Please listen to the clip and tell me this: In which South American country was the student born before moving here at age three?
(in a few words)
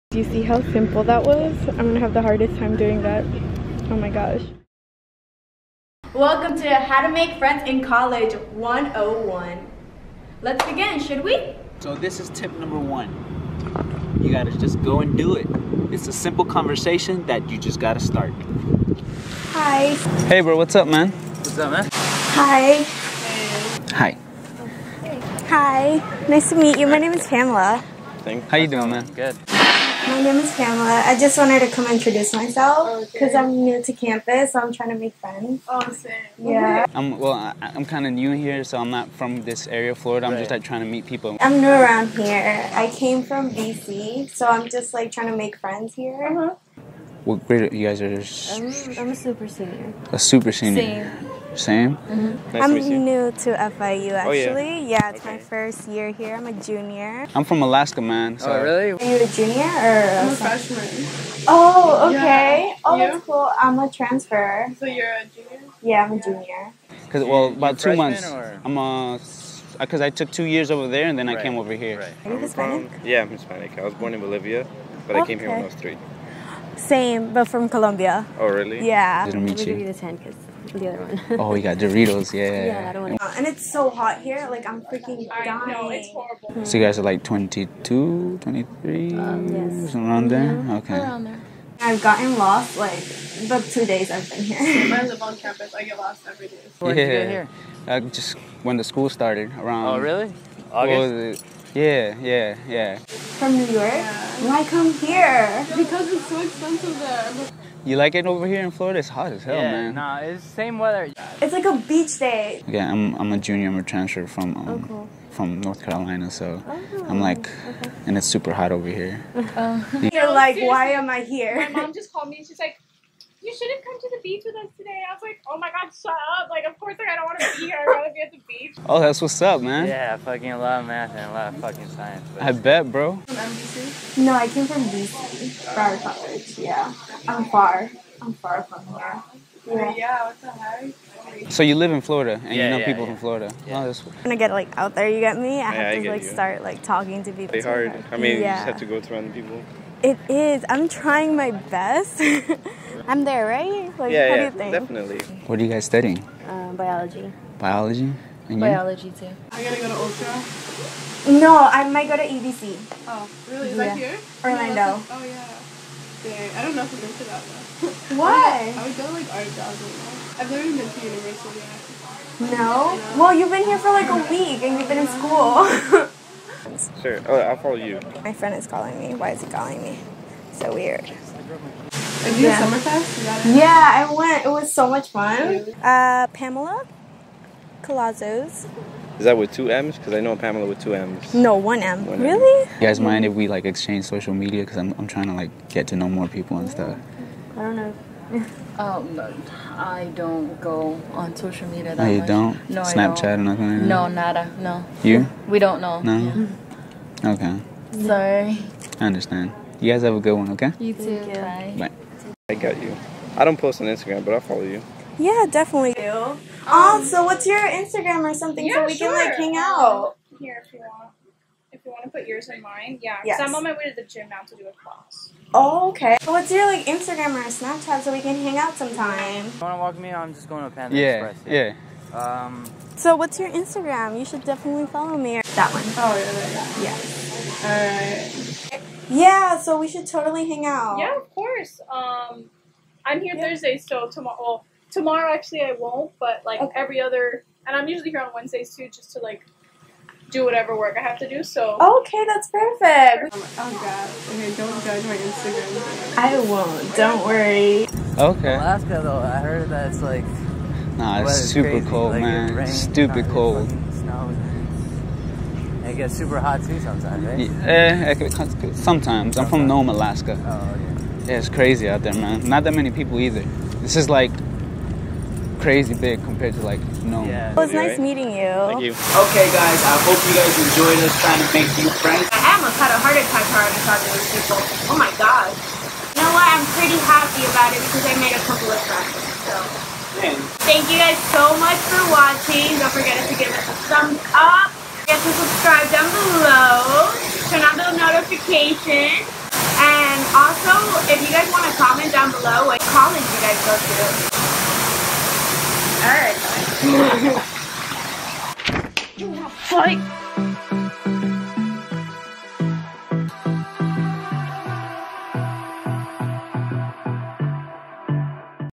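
Bolivia.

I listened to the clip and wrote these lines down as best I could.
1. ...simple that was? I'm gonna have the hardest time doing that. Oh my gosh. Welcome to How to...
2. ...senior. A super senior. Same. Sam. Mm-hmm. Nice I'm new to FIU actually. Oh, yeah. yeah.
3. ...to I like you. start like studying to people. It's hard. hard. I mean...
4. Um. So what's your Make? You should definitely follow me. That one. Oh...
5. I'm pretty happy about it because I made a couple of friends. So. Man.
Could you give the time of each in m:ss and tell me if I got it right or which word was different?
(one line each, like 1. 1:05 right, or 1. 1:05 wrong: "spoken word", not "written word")
1. 0:00 right
2. 0:49 right
3. 2:26 wrong: "talking", not "studying"
4. 3:52 wrong: "Instagram", not "Make"
5. 4:46 right.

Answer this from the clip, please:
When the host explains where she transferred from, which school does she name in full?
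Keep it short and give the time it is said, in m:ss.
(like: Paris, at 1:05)
Broward College, at 2:15.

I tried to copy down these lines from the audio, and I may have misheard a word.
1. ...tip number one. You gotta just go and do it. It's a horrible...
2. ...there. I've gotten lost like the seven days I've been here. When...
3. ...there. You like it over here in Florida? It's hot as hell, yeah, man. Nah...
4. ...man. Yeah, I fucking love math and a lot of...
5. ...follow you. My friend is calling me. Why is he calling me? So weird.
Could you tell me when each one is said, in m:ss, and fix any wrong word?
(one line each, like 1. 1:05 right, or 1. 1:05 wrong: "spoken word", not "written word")
1. 0:12 wrong: "simple", not "horrible"
2. 1:31 wrong: "two", not "seven"
3. 1:46 right
4. 2:09 right
5. 2:57 right.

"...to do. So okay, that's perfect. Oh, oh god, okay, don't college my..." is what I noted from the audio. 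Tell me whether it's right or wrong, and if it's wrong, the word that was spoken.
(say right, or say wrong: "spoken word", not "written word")
wrong: "judge", not "college".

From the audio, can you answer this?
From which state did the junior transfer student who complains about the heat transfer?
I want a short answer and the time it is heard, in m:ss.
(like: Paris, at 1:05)
North Carolina, at 1:55.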